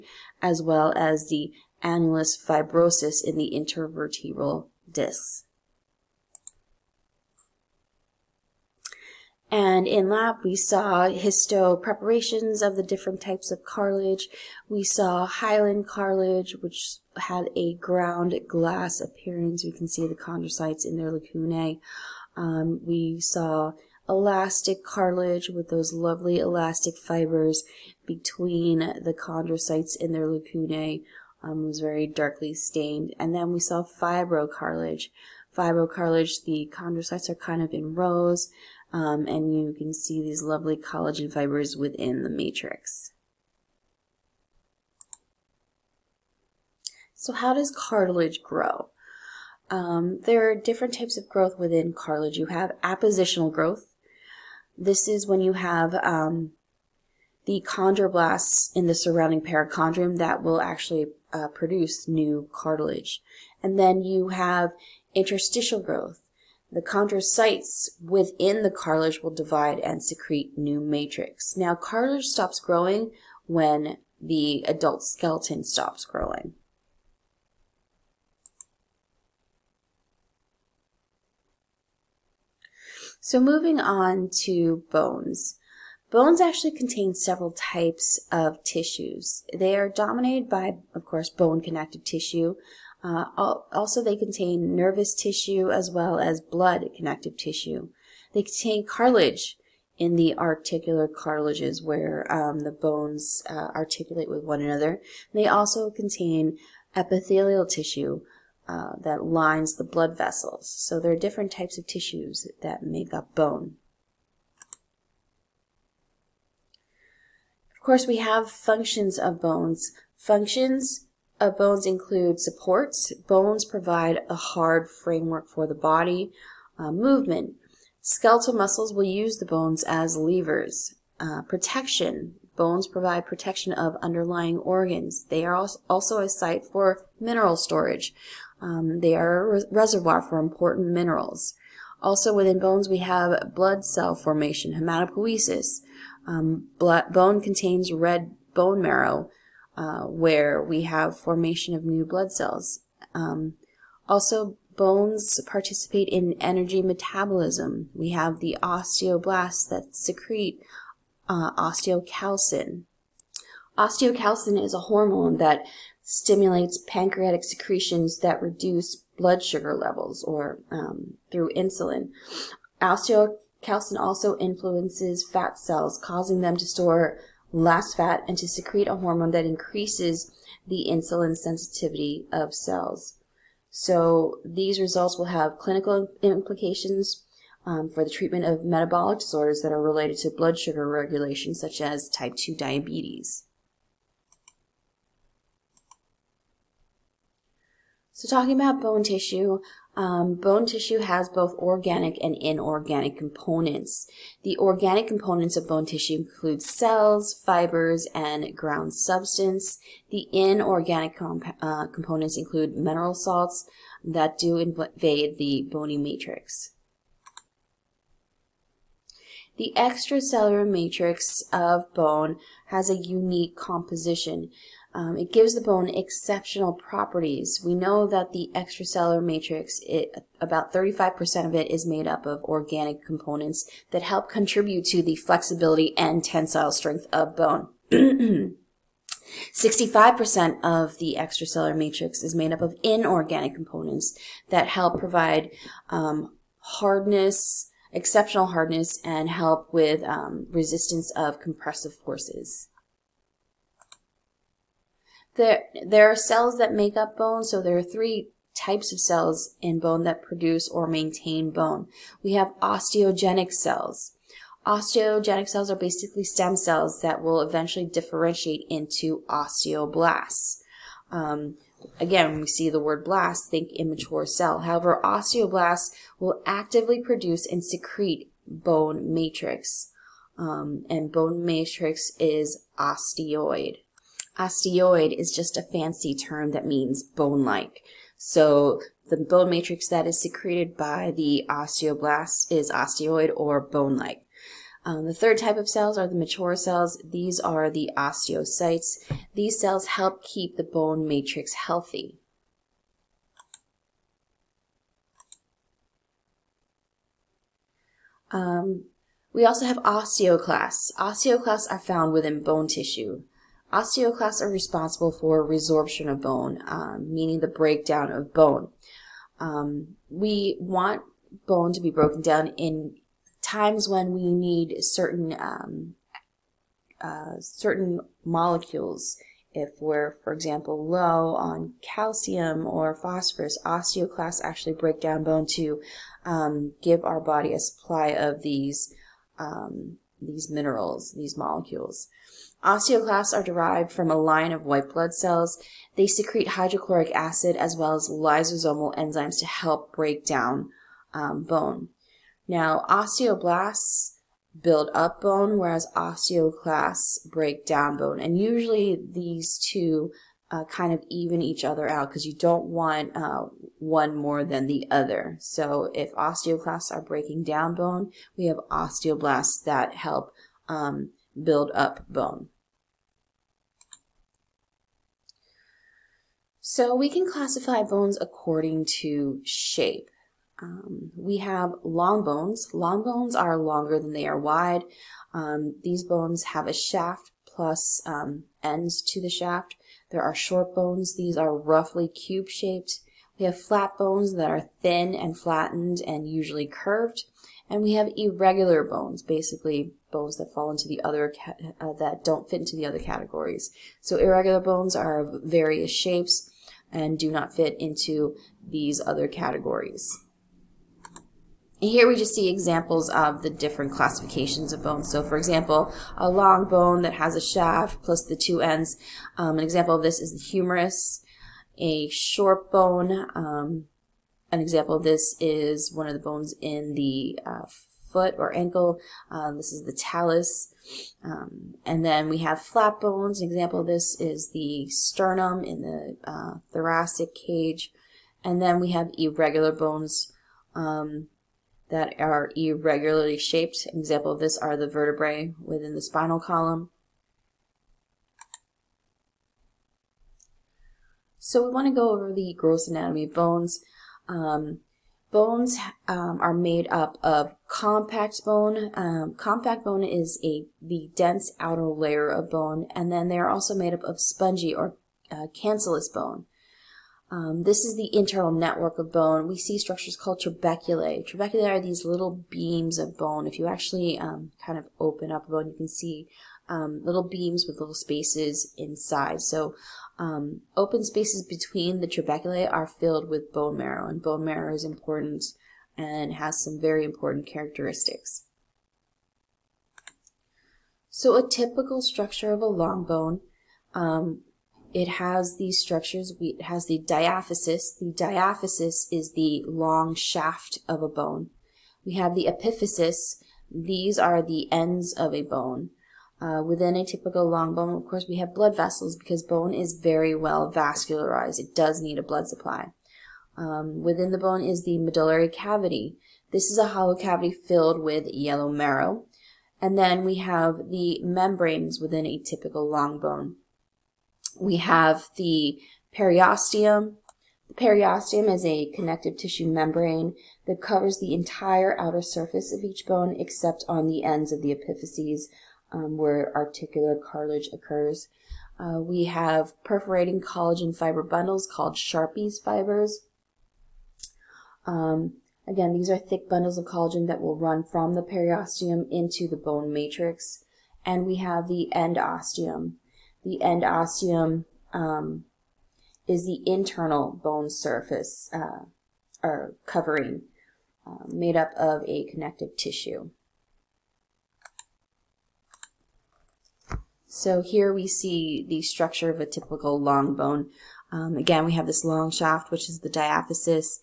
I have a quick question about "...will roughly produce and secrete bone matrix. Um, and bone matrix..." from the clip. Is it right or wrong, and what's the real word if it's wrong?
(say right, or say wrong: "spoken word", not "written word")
wrong: "actively", not "roughly".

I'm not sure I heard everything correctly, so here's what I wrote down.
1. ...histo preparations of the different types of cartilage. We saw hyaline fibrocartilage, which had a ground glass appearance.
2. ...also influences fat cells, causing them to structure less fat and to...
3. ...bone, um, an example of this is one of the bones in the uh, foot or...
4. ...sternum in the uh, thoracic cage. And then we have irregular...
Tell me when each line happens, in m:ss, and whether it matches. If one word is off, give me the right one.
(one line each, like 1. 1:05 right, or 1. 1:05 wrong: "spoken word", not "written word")
1. 0:11 wrong: "cartilage", not "fibrocartilage"
2. 2:53 wrong: "store", not "structure"
3. 7:02 right
4. 7:14 right.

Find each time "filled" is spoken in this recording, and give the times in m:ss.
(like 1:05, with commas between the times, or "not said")
8:02, 8:37.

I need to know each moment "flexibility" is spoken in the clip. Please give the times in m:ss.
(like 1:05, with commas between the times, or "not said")
3:55.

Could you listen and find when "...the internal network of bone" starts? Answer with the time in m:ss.
7:47.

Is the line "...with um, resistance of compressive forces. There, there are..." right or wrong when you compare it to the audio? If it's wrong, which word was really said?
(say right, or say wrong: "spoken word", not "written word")
right.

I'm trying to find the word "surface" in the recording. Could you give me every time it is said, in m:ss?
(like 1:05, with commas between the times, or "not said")
8:52, 9:17.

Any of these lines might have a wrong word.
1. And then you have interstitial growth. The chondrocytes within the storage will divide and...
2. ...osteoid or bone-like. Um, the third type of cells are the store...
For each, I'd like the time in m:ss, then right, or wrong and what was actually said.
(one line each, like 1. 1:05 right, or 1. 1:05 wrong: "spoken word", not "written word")
1. 1:03 wrong: "cartilage", not "storage"
2. 4:52 wrong: "mature", not "store".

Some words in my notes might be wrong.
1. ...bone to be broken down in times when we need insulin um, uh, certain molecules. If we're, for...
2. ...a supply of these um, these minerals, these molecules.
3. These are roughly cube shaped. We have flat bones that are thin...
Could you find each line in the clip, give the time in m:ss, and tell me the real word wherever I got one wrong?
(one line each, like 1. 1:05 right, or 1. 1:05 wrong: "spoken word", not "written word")
1. 5:21 wrong: "certain", not "insulin"
2. 5:37 right
3. 6:31 right.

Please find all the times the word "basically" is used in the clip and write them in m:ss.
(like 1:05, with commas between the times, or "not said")
4:25, 6:39.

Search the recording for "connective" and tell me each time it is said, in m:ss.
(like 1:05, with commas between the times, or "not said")
1:31, 1:36, 8:48, 9:22.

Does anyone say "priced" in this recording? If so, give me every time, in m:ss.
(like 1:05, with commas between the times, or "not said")
not said.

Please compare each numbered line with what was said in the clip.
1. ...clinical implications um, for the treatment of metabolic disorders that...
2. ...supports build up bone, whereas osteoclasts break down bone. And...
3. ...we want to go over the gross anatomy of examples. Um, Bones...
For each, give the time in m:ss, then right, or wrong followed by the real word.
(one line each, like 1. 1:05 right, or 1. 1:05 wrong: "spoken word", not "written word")
1. 3:05 right
2. 5:52 wrong: "osteoblasts", not "supports"
3. 7:31 wrong: "bones", not "examples".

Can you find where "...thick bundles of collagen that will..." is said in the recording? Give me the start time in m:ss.
9:06.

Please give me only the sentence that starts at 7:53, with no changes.
If you actually um, kind of open up a bone, you can see um, little beams with little spaces inside.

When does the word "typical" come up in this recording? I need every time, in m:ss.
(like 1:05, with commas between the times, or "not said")
8:11, 8:27, 8:42, 9:29.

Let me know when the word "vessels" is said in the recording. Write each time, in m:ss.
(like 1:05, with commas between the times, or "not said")
1:50, 8:28.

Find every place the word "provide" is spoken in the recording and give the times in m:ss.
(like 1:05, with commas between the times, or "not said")
2:03, 2:12, 4:04.